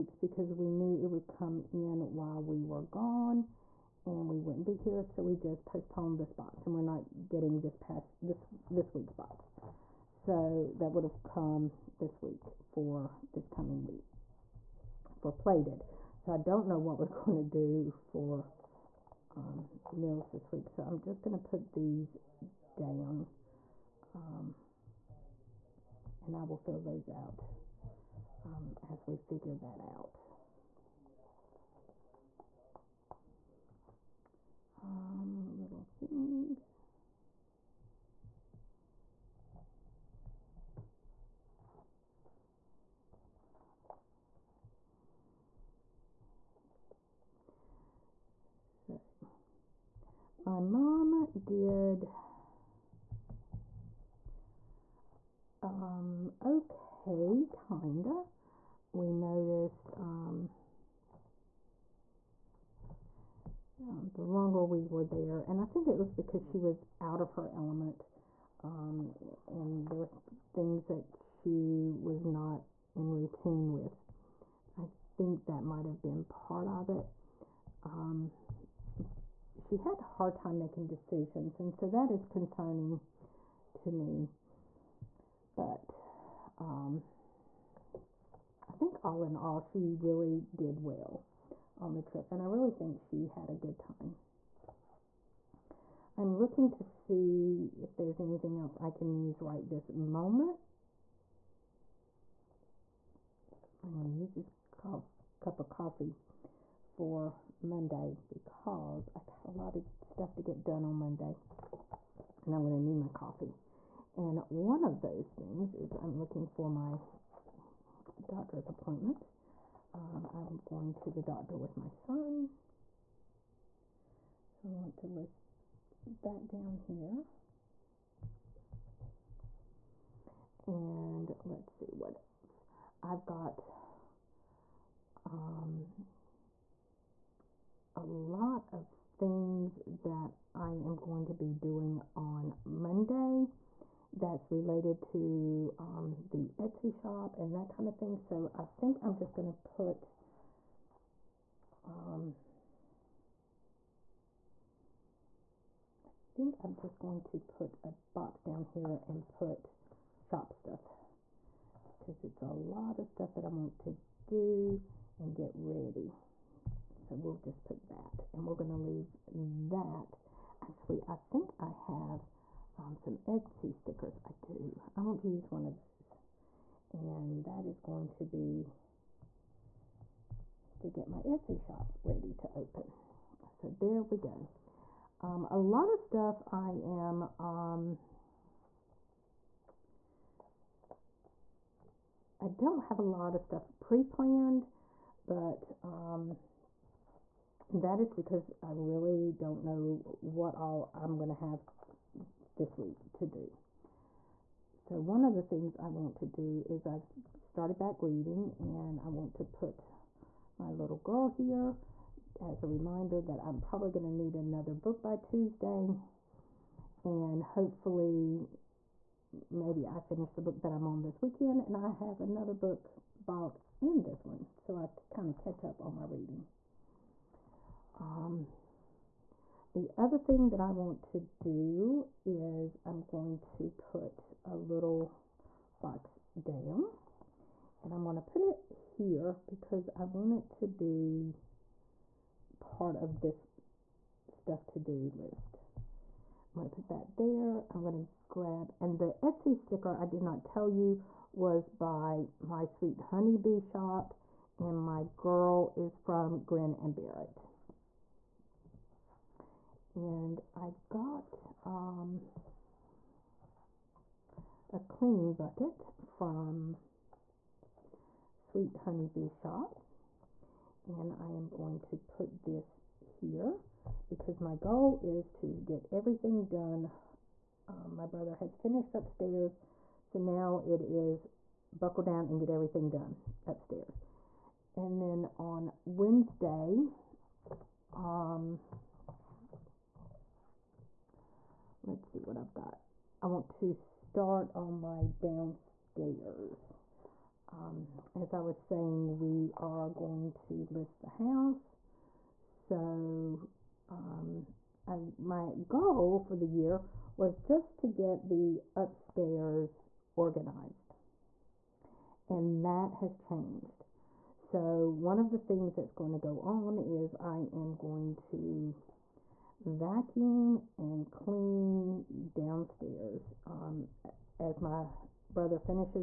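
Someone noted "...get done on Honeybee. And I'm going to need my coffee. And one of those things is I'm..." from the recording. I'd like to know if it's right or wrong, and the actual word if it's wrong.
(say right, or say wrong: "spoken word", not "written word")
wrong: "Monday", not "Honeybee".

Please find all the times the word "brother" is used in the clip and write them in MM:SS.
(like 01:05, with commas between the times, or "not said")
04:38, 05:25.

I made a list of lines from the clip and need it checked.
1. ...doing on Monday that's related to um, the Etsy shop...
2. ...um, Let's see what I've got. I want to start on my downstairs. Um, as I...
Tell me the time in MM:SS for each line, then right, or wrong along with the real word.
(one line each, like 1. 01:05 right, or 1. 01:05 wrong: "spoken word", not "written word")
1. 02:21 right
2. 04:47 right.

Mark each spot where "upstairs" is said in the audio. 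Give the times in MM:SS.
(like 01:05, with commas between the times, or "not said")
04:38, 04:43, 05:08.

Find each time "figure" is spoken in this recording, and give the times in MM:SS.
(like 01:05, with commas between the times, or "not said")
00:29.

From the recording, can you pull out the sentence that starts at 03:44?
So I kind of catch up on my reading.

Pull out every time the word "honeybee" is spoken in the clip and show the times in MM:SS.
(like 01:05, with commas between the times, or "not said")
04:12, 04:28.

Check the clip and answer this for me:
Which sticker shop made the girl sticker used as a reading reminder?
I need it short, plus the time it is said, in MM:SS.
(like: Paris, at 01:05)
Grin and Bear It, at 04:16.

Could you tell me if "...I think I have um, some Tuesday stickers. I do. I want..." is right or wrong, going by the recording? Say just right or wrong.
wrong.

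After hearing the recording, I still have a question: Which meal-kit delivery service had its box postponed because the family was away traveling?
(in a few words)
Plated.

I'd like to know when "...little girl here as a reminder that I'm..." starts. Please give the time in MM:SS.
03:30.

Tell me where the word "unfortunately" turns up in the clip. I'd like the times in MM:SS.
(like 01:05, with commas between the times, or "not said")
not said.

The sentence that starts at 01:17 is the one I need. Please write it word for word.
Um, she had a hard time making decisions, and so that is concerning to me.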